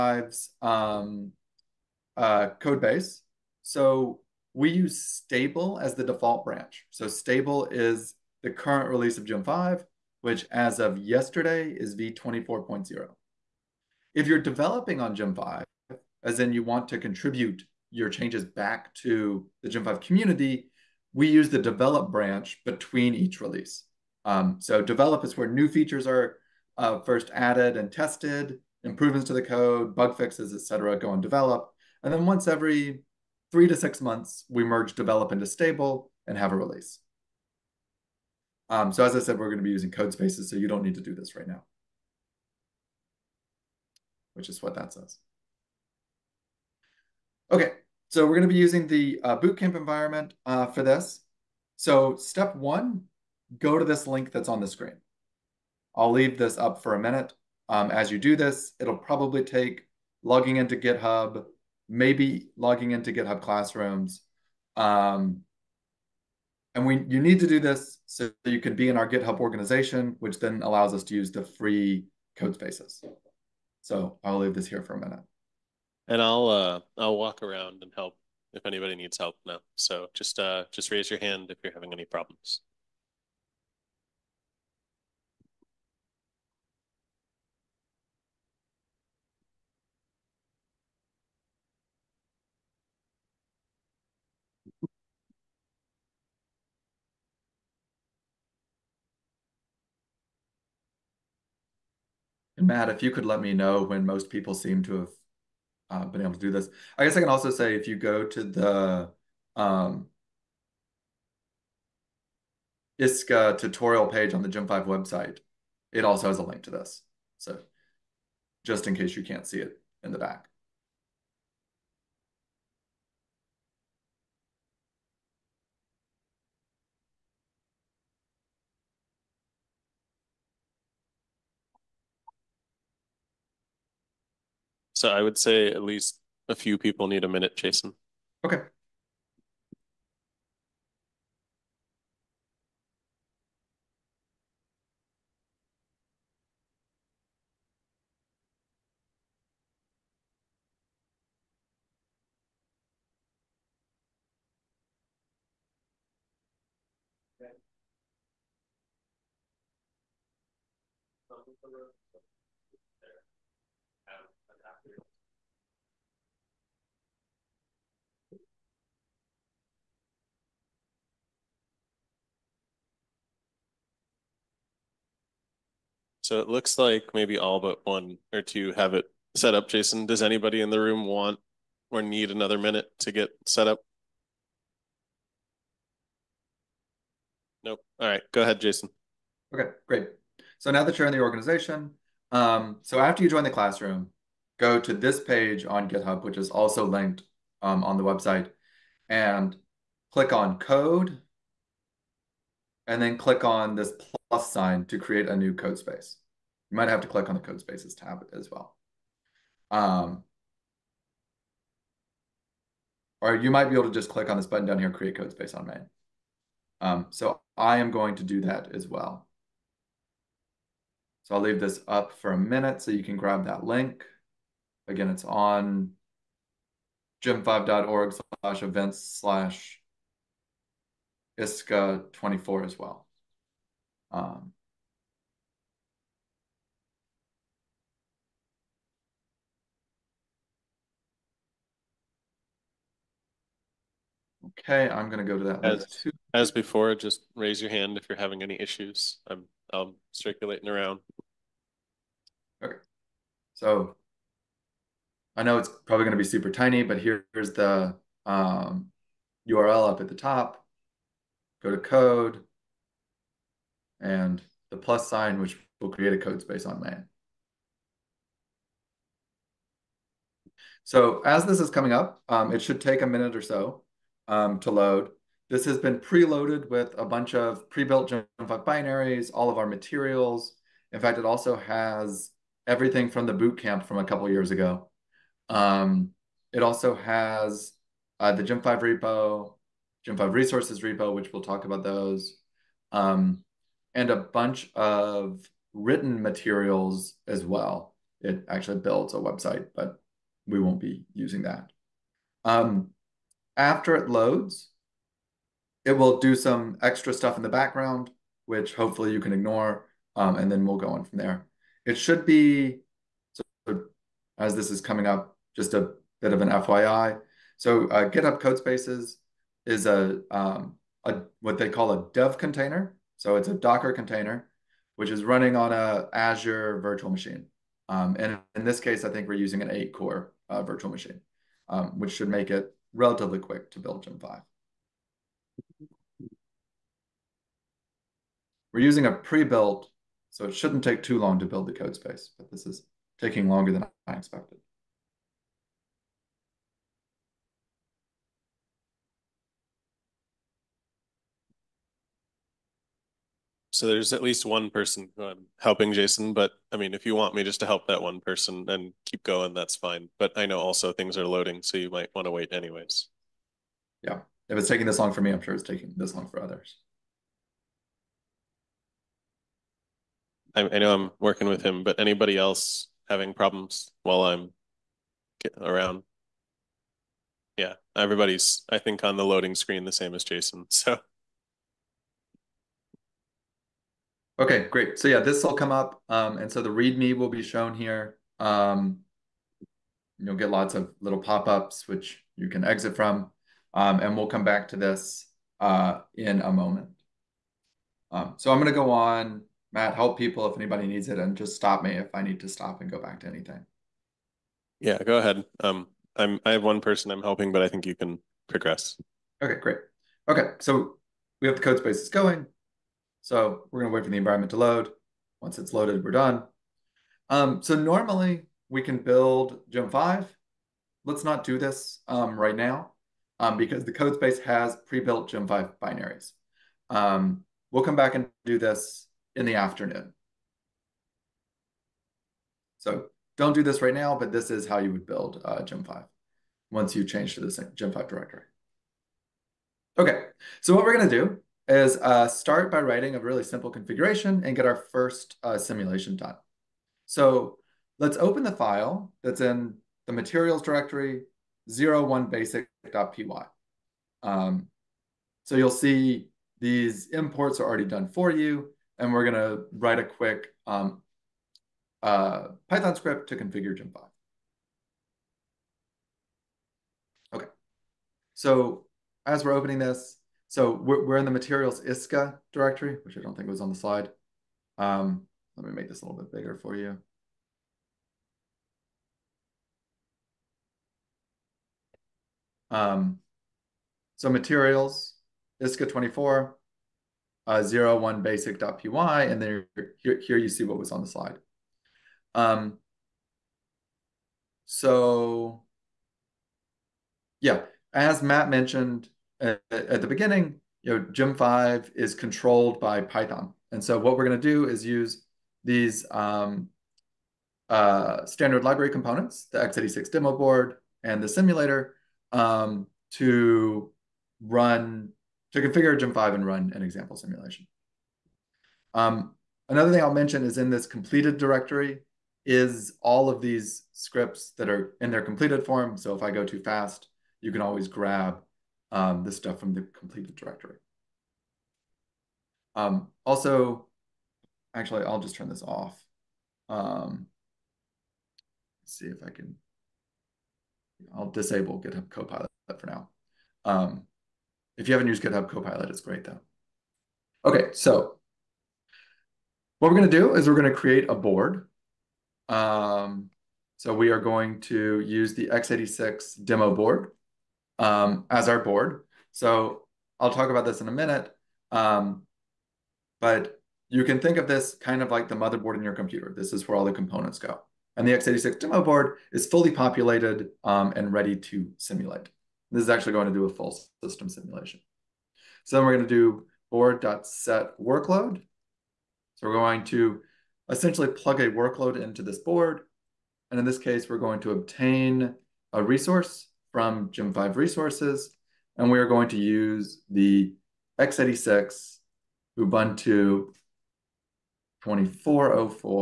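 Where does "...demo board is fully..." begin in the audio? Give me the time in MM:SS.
09:28.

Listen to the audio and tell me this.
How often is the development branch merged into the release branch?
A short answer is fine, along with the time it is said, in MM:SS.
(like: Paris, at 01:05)
every 3 to 6 months, at 00:32.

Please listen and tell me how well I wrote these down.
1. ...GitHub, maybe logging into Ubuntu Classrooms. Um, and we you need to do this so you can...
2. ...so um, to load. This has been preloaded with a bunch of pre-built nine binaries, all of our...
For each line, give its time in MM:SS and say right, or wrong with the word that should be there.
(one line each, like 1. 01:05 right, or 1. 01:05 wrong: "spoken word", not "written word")
1. 01:00 wrong: "GitHub", not "Ubuntu"
2. 04:33 wrong: "five", not "nine".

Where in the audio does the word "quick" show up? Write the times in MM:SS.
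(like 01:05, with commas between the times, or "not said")
05:33, 07:40.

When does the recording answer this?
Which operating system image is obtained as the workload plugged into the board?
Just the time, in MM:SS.
09:50.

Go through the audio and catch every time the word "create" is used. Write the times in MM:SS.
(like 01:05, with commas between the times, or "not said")
03:24, 03:34, 04:25, 09:10.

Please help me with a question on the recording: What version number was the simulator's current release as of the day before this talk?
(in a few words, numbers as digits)
v24.0.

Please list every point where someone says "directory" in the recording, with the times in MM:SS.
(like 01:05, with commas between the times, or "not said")
07:18, 07:30, 07:52, 08:41, 08:50.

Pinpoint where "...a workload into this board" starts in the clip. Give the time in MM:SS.
09:41.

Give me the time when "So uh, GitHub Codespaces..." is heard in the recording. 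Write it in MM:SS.
05:17.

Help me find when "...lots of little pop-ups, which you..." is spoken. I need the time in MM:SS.
06:30.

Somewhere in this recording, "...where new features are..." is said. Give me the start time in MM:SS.
00:25.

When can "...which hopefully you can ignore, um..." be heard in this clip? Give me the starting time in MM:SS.
05:08.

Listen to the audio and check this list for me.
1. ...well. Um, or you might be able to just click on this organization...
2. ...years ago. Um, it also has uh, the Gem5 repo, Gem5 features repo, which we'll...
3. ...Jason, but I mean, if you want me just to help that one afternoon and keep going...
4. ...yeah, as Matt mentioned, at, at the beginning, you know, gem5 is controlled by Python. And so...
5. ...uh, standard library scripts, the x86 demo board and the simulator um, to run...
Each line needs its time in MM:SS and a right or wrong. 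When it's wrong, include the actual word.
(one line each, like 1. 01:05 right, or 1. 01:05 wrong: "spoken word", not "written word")
1. 03:28 wrong: "button", not "organization"
2. 04:44 wrong: "resources", not "features"
3. 05:55 wrong: "person", not "afternoon"
4. 08:17 right
5. 08:27 wrong: "components", not "scripts".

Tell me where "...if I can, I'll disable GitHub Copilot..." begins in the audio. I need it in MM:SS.
08:59.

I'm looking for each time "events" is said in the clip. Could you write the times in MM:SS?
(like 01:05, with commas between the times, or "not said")
03:48.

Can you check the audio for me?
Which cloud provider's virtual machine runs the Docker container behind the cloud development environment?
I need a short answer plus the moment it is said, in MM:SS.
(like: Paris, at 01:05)
Azure, at 05:26.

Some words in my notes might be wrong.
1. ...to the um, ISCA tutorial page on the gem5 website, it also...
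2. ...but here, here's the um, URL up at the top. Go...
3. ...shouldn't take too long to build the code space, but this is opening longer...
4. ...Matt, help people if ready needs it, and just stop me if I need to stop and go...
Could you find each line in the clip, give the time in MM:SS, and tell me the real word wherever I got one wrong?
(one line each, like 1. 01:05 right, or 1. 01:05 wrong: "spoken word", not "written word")
1. 01:48 right
2. 04:16 right
3. 05:40 wrong: "taking", not "opening"
4. 06:39 wrong: "anybody", not "ready".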